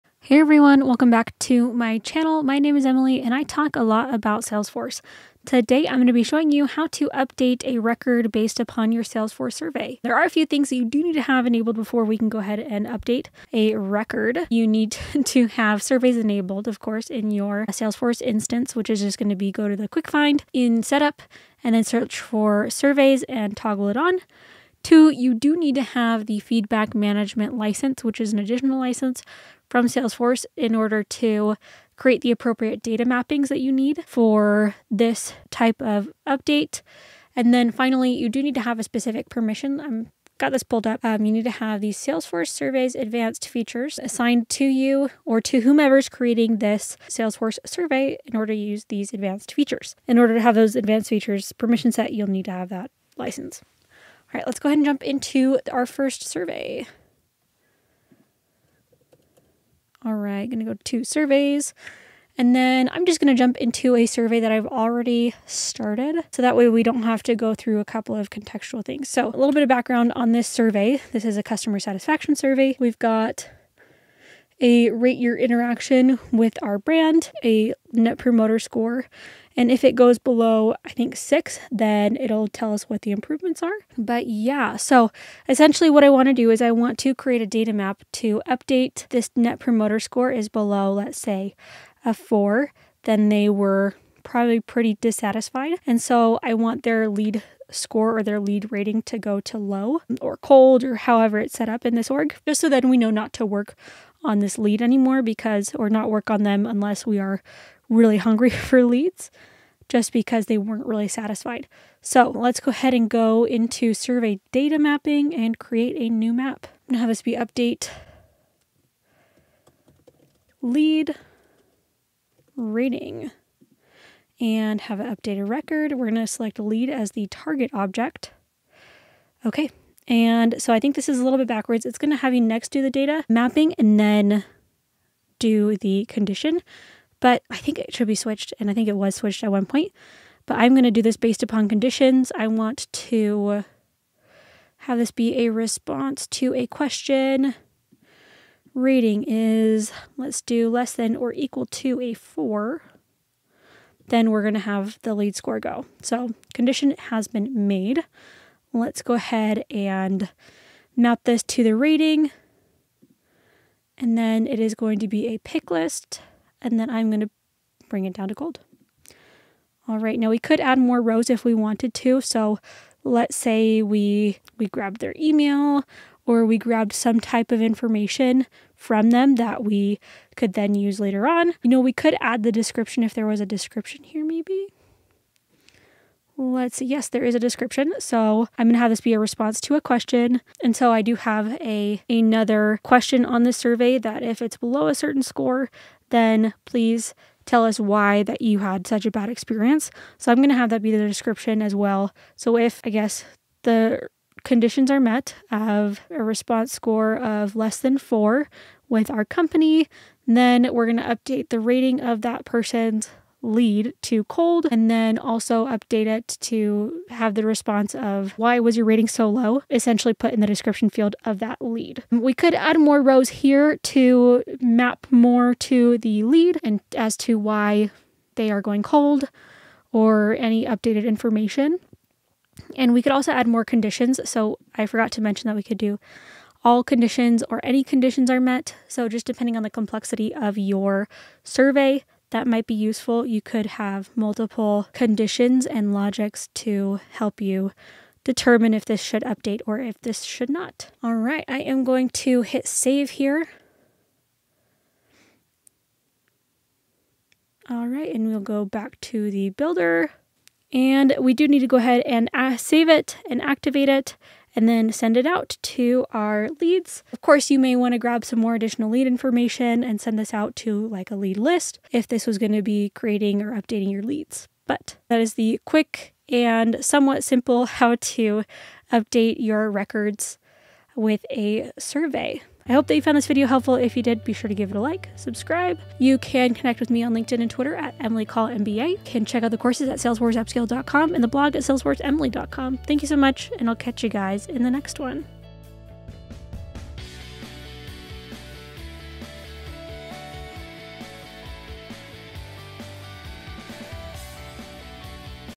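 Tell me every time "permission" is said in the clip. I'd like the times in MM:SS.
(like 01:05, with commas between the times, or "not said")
00:39, 00:51.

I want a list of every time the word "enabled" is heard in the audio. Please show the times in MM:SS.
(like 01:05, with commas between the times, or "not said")
00:11, 00:16.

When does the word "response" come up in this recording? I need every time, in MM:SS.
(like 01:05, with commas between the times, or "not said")
02:25, 03:09, 03:26, 03:37.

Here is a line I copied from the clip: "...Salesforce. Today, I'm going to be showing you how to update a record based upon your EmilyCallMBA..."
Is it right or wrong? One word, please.
wrong.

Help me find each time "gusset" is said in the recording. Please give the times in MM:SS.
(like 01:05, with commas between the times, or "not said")
not said.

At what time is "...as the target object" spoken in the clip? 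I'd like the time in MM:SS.
02:06.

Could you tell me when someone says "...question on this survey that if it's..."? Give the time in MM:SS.
03:12.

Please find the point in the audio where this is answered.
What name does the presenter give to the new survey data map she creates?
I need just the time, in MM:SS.
01:57.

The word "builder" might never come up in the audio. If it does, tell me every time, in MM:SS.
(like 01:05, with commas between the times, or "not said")
04:19.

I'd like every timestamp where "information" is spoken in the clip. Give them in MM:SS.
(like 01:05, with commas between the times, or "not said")
02:57, 03:51, 04:29.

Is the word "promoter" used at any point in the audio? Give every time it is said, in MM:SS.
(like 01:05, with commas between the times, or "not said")
01:18, 01:29.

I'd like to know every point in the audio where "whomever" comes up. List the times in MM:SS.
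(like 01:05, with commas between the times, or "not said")
00:45.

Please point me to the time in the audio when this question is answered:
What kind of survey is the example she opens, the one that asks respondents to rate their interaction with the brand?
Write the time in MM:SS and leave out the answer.
01:11.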